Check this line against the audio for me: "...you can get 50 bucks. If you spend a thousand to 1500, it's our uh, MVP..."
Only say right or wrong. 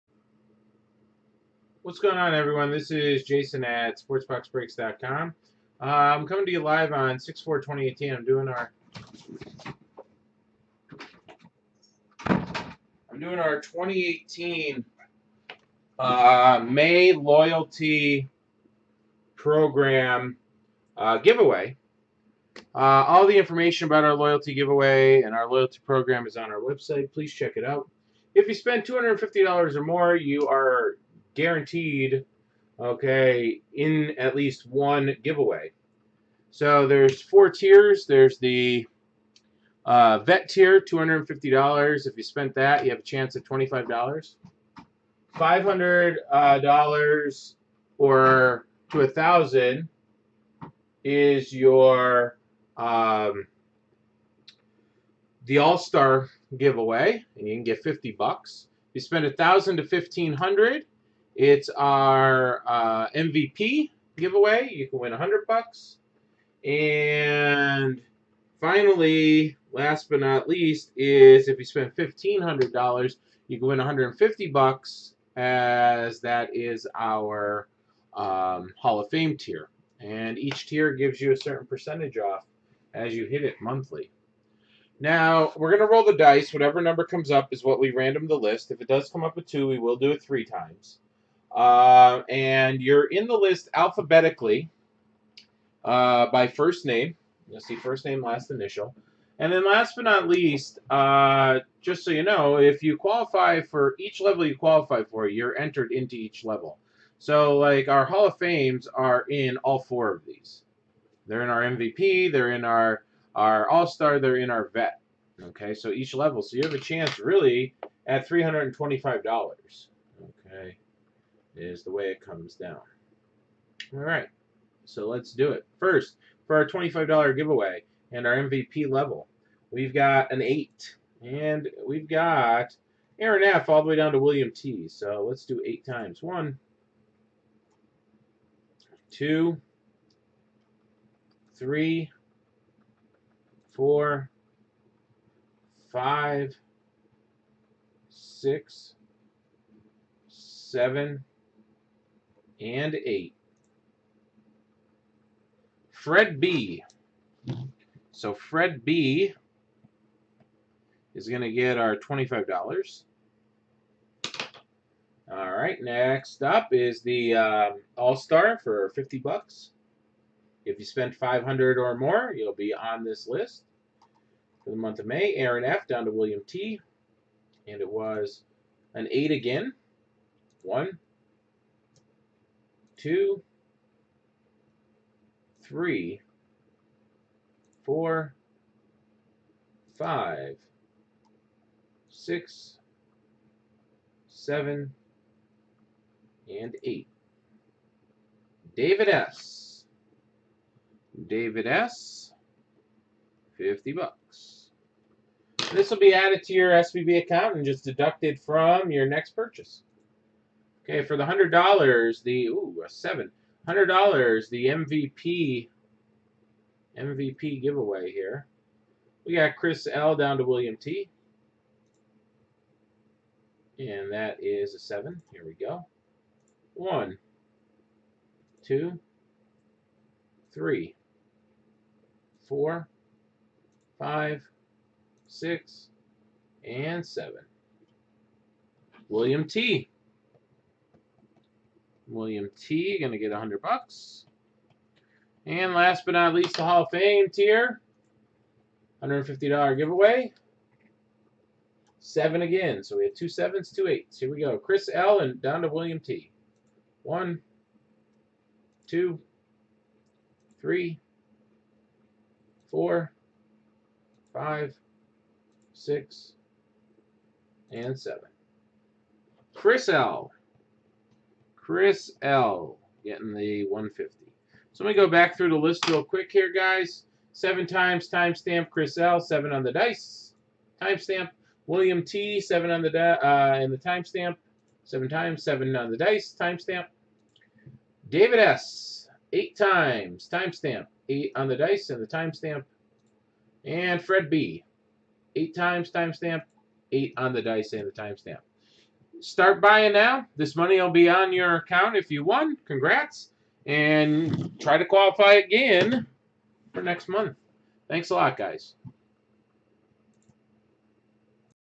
right.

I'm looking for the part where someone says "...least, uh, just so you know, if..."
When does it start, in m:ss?
1:40.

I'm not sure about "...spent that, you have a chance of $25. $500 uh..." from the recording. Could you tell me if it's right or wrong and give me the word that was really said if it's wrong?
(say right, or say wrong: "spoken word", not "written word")
right.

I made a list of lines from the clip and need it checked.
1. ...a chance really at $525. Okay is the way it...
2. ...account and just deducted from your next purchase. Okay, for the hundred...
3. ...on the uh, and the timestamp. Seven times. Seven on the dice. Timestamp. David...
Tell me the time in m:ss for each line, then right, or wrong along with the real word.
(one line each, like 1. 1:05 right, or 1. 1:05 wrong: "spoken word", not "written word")
1. 1:56 wrong: "325", not "525"
2. 3:27 right
3. 4:42 right.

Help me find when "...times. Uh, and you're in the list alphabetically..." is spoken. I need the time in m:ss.
1:30.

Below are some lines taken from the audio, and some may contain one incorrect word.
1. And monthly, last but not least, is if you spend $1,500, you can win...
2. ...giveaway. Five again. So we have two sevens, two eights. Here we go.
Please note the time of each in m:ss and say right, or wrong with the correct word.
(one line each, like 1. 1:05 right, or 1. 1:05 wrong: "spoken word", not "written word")
1. 1:06 wrong: "finally", not "monthly"
2. 4:09 wrong: "Seven", not "Five".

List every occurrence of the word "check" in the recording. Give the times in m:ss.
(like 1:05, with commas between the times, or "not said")
0:27.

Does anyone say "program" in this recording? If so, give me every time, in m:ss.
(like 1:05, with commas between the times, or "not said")
0:19, 0:25.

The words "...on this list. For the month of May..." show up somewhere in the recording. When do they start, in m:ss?
2:52.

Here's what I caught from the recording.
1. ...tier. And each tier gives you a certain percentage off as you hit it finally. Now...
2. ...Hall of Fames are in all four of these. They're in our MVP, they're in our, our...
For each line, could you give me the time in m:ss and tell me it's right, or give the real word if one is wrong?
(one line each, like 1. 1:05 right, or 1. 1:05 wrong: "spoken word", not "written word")
1. 1:19 wrong: "monthly", not "finally"
2. 1:48 right.